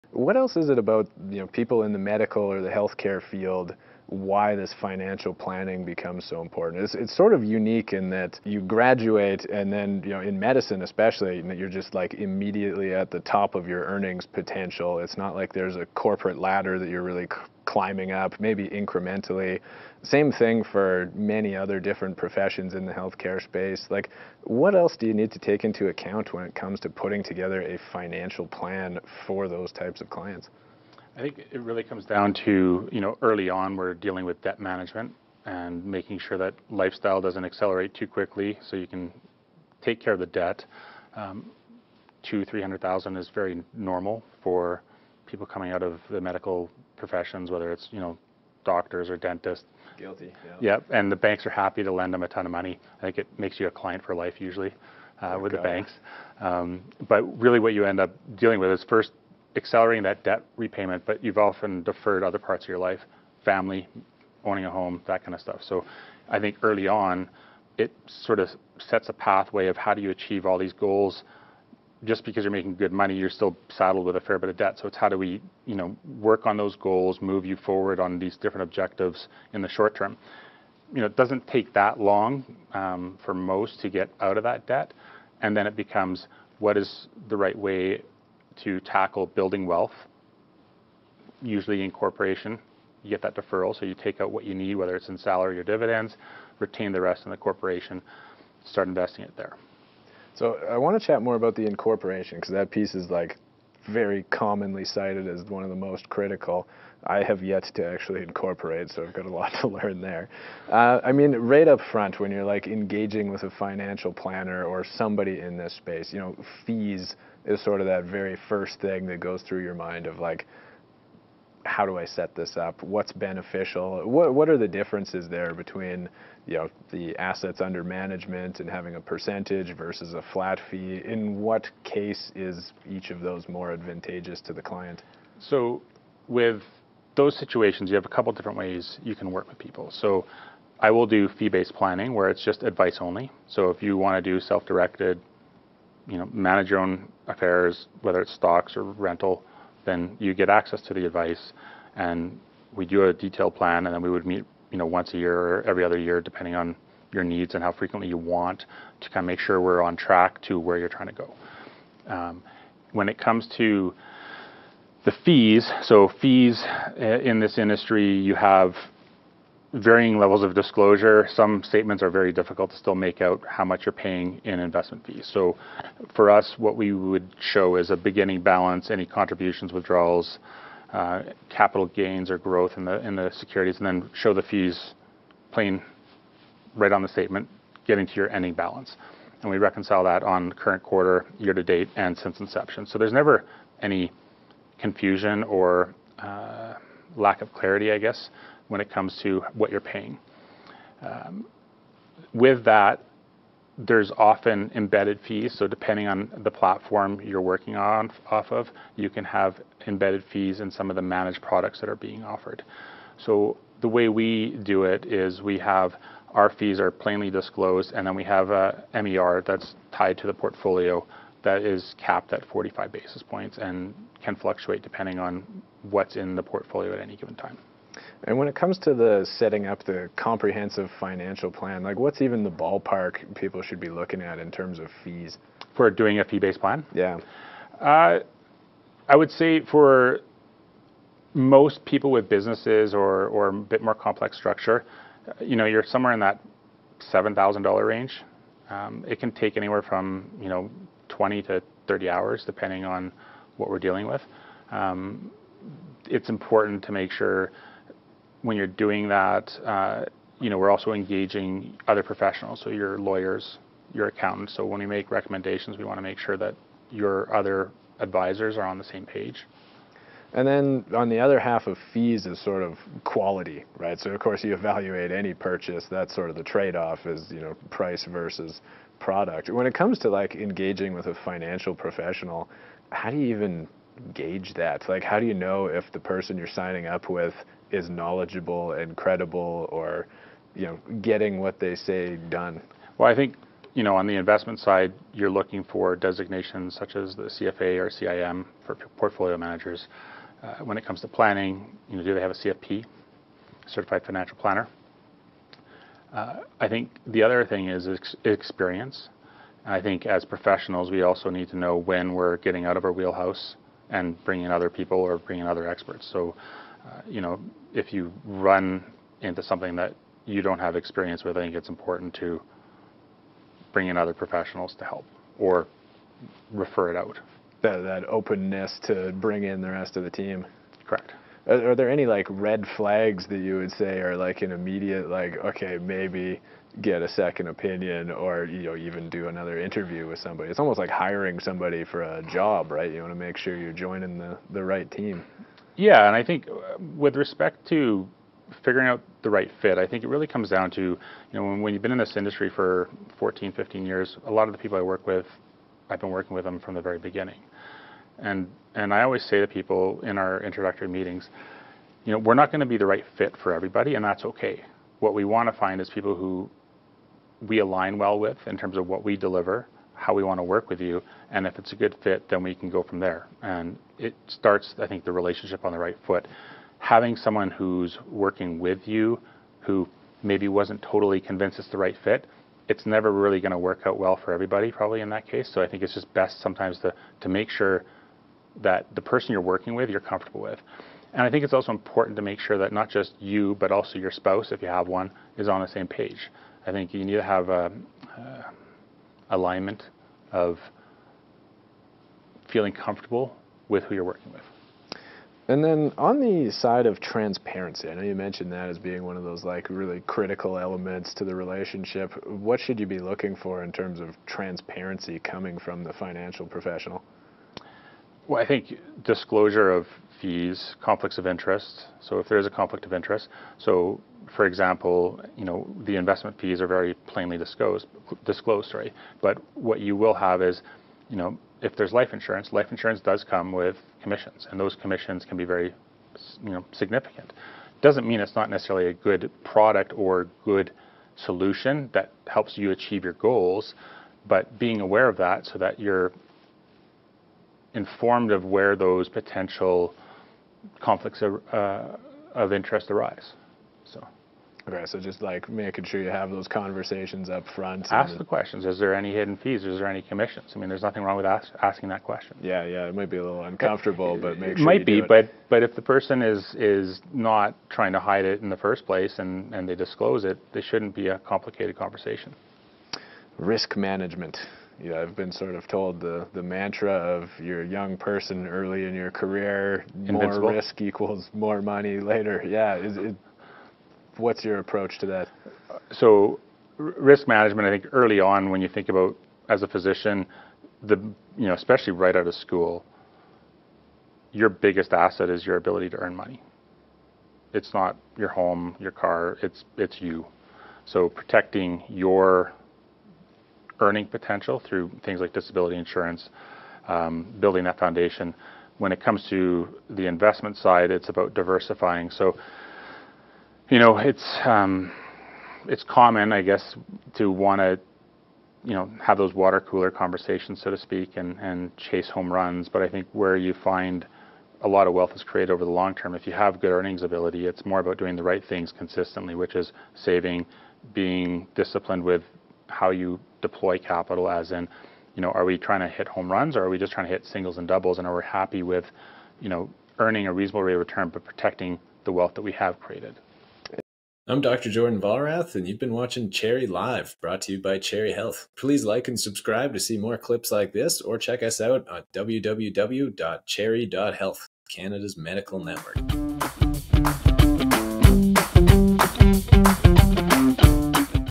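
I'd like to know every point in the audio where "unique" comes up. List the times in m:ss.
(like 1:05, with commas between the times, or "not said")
0:07.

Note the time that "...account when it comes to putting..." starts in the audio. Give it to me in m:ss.
0:25.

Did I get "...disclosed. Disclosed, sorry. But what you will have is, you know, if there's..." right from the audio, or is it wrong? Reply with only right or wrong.
right.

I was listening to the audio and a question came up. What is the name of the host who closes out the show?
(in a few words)
Jordan Valrath.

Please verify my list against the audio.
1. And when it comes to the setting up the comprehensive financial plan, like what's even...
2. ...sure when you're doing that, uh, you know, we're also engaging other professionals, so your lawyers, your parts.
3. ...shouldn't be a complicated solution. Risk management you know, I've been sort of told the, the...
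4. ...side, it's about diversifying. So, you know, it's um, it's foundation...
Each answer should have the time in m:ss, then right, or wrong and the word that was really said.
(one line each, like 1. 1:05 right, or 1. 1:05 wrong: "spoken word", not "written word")
1. 3:48 right
2. 4:17 wrong: "accountants", not "parts"
3. 7:50 wrong: "conversation", not "solution"
4. 8:30 wrong: "common", not "foundation".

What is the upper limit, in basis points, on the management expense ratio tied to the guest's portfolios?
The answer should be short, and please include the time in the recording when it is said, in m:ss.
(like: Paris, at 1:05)
45 basis points, at 3:42.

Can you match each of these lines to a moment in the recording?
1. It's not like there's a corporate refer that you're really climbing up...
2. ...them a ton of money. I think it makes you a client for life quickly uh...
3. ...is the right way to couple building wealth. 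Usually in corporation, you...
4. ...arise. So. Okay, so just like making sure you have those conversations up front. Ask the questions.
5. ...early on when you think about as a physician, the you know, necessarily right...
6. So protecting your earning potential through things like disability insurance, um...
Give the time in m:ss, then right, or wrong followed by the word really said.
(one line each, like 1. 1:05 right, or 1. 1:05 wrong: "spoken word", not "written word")
1. 0:14 wrong: "ladder", not "refer"
2. 0:52 wrong: "usually", not "quickly"
3. 1:26 wrong: "tackle", not "couple"
4. 7:32 right
5. 8:07 wrong: "especially", not "necessarily"
6. 8:20 right.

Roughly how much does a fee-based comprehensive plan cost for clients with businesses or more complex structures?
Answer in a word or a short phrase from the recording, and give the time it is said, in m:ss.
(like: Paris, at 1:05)
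$7,000, at 4:07.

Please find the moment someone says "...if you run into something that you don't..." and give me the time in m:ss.
5:17.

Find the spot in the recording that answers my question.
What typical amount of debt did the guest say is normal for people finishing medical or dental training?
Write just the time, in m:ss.
0:42.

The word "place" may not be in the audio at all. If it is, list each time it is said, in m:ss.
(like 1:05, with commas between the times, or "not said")
7:48.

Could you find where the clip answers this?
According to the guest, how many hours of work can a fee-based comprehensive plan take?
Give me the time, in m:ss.
4:11.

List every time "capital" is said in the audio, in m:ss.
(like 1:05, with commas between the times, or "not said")
3:01, 8:53.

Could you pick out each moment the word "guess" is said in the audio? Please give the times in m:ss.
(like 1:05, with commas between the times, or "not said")
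3:17, 8:36.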